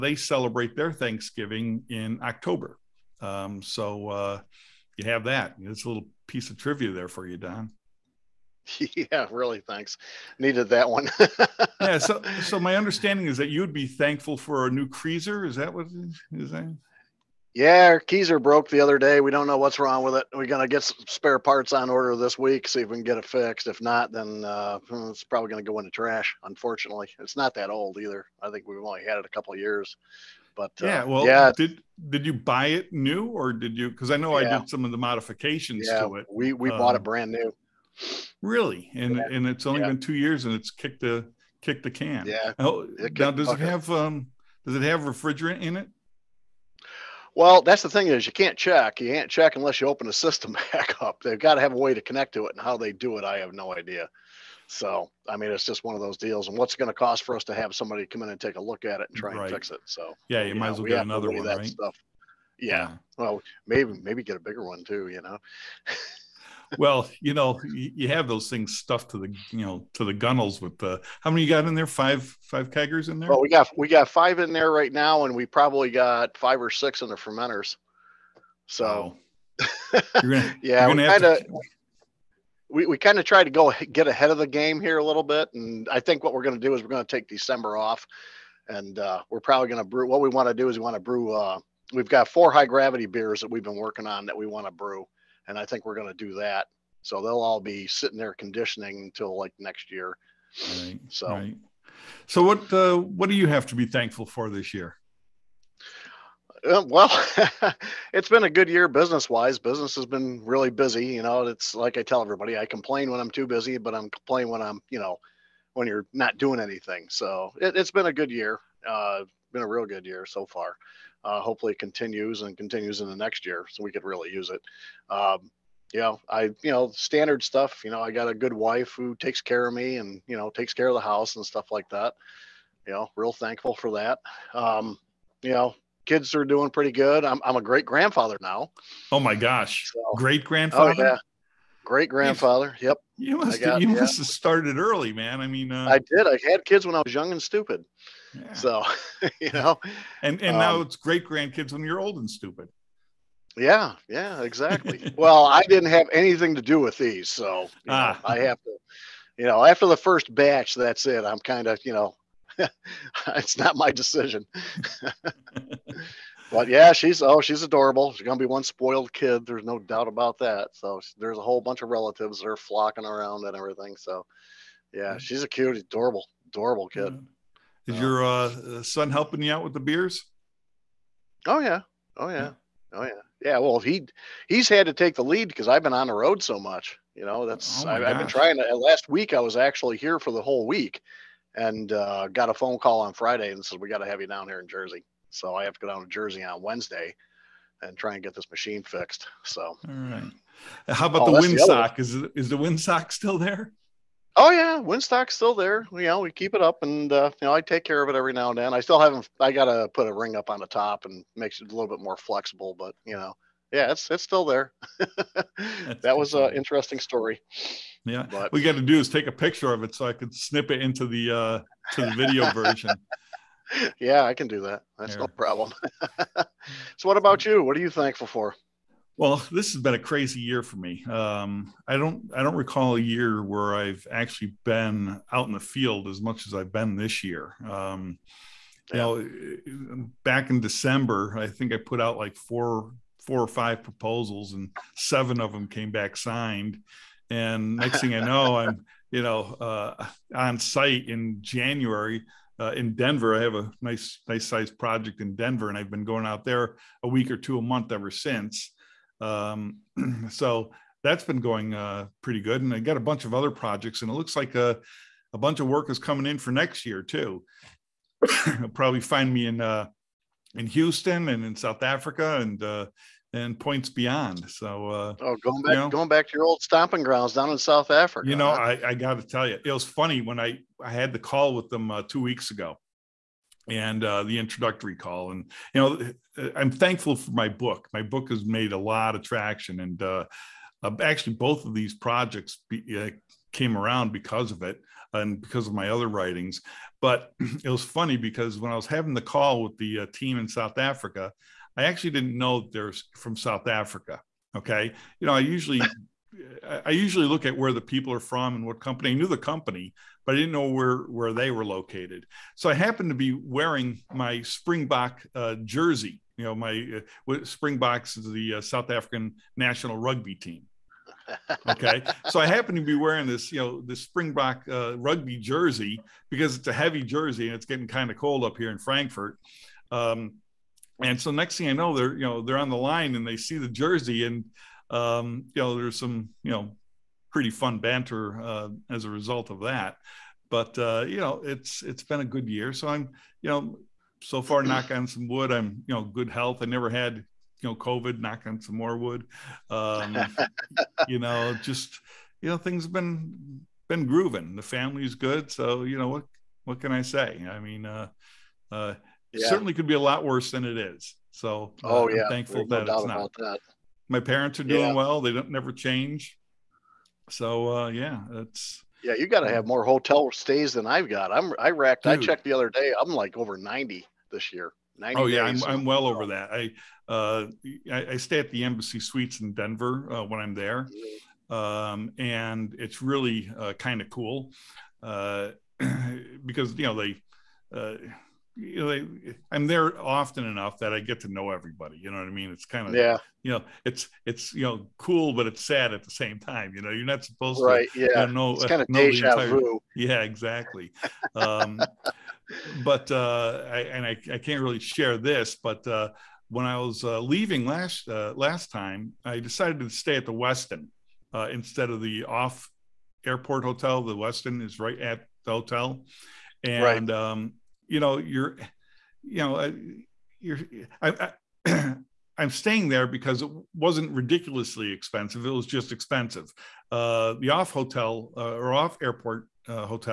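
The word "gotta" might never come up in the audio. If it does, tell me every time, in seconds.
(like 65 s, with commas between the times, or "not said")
209 s.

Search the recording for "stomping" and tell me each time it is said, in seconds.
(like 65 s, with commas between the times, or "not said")
276 s.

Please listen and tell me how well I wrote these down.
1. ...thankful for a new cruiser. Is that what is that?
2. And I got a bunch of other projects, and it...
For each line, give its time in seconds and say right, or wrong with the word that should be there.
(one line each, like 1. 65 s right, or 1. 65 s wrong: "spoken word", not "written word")
1. 13 s right
2. 262 s right.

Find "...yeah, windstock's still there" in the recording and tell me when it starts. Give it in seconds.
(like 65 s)
204 s.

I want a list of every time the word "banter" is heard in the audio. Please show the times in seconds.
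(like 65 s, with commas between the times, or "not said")
337 s.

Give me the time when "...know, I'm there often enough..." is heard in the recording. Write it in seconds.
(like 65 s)
388 s.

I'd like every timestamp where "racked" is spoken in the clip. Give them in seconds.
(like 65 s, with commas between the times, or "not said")
371 s.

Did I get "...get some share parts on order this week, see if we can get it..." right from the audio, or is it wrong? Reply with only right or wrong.
wrong.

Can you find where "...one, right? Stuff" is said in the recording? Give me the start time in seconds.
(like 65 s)
61 s.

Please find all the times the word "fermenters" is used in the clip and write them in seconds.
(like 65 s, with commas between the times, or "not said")
77 s.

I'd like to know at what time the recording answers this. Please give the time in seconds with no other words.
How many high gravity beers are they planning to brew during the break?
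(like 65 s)
92 s.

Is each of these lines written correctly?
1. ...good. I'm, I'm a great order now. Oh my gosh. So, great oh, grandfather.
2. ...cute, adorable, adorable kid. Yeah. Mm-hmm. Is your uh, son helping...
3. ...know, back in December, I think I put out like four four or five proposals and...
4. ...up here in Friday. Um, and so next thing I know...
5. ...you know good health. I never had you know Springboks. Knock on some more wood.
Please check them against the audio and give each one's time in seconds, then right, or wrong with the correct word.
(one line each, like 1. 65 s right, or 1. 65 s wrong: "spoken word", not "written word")
1. 136 s wrong: "grandfather", not "order"
2. 175 s right
3. 238 s right
4. 328 s wrong: "Frankfurt", not "Friday"
5. 345 s wrong: "COVID", not "Springboks".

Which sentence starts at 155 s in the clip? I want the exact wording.
well, I didn't have anything to do with these, so ah.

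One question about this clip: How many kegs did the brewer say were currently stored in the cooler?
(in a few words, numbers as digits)
5.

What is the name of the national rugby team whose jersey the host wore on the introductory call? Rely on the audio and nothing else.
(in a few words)
Springboks.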